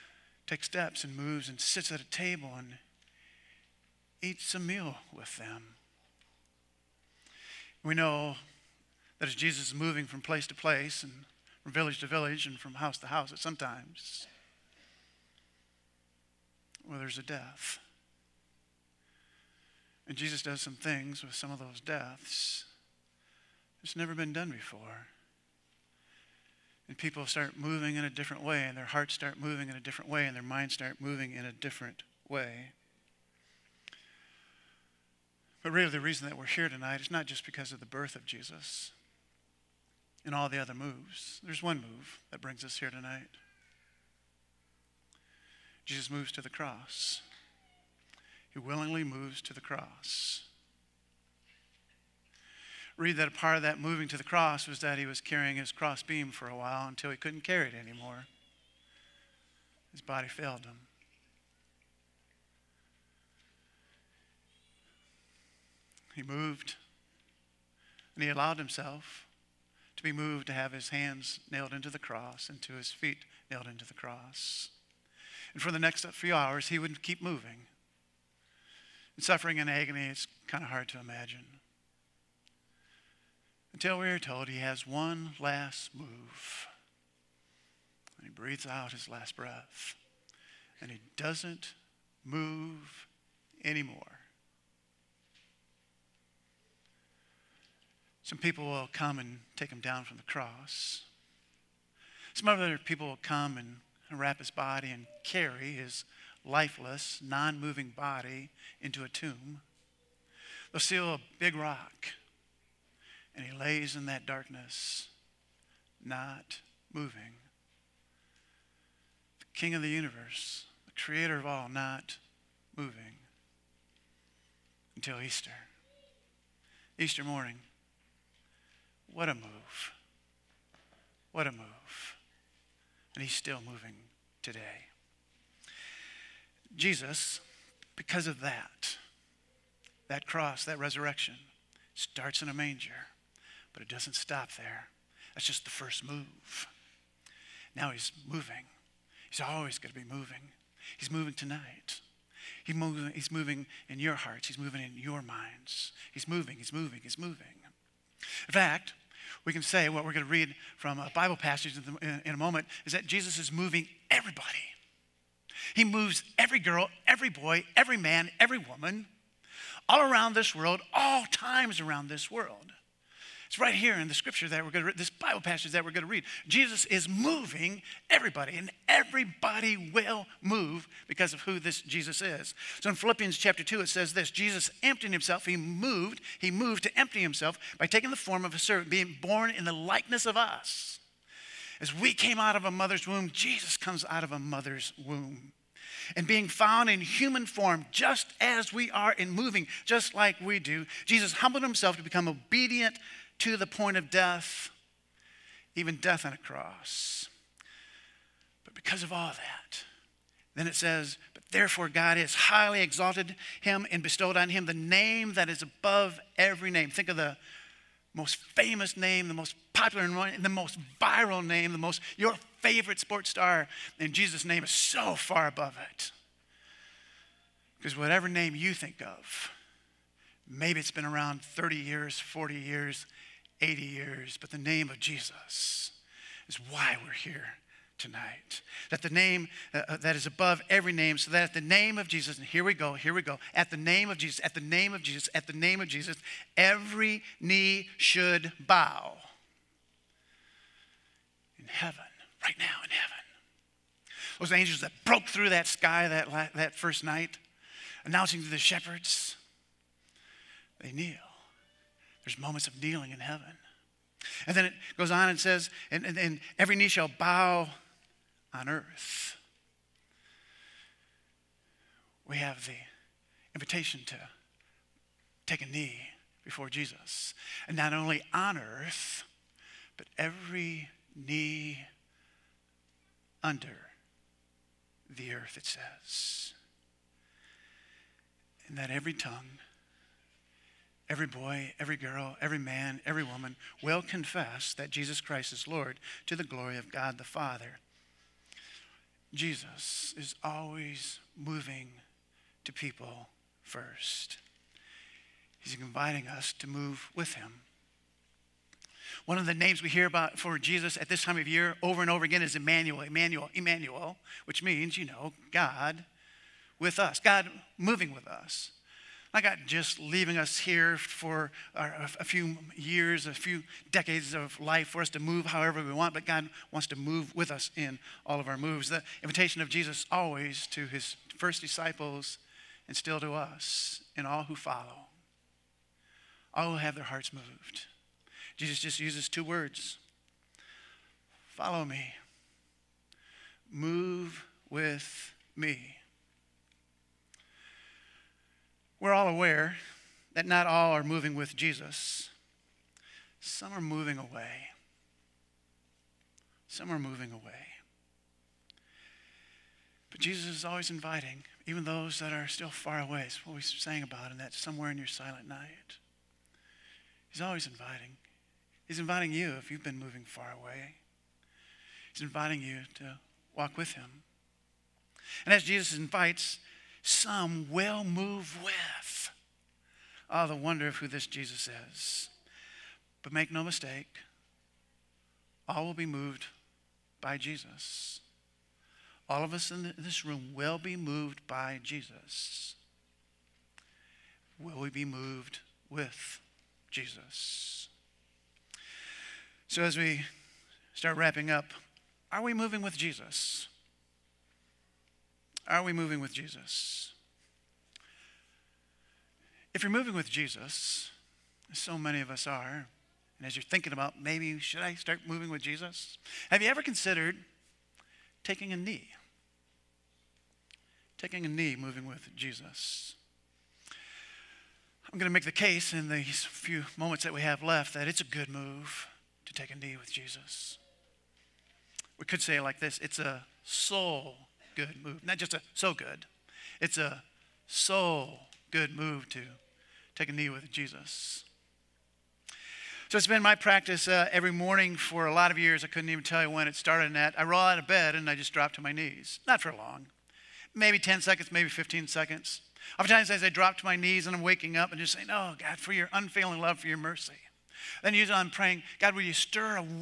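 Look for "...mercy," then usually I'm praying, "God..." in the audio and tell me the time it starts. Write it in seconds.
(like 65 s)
456 s.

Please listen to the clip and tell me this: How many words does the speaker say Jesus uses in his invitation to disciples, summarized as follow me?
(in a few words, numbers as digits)
2.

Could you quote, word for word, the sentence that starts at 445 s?
I couldn't even tell you when it started.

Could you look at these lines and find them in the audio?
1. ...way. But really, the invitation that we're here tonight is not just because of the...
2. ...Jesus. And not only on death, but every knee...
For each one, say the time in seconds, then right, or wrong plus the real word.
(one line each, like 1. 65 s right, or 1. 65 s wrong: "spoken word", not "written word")
1. 32 s wrong: "reason", not "invitation"
2. 276 s wrong: "earth", not "death".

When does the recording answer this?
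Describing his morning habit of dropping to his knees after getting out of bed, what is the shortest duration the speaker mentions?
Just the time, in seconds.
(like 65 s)
450 s.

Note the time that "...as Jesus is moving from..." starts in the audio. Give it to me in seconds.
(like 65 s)
9 s.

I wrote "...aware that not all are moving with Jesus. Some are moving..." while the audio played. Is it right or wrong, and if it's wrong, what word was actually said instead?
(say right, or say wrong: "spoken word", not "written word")
right.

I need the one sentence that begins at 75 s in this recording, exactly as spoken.
And for the next few hours, he would keep moving.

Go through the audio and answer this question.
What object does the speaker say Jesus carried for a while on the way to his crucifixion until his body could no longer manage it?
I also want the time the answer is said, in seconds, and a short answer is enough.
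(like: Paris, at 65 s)
His cross beam, at 55 s.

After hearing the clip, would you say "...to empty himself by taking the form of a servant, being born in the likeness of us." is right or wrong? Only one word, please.
right.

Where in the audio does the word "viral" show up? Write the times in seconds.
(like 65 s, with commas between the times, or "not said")
220 s.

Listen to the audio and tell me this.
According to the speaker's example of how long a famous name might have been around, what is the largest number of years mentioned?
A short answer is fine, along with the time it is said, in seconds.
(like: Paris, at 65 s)
80, at 233 s.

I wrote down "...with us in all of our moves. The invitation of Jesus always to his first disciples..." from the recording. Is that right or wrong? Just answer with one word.
right.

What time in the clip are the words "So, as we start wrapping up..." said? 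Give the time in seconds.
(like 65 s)
399 s.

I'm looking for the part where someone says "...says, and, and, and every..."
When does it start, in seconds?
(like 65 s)
265 s.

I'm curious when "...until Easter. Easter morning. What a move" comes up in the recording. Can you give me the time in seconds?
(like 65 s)
124 s.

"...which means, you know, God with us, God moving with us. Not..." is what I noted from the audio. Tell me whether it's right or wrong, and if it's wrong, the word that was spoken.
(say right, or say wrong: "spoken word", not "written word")
right.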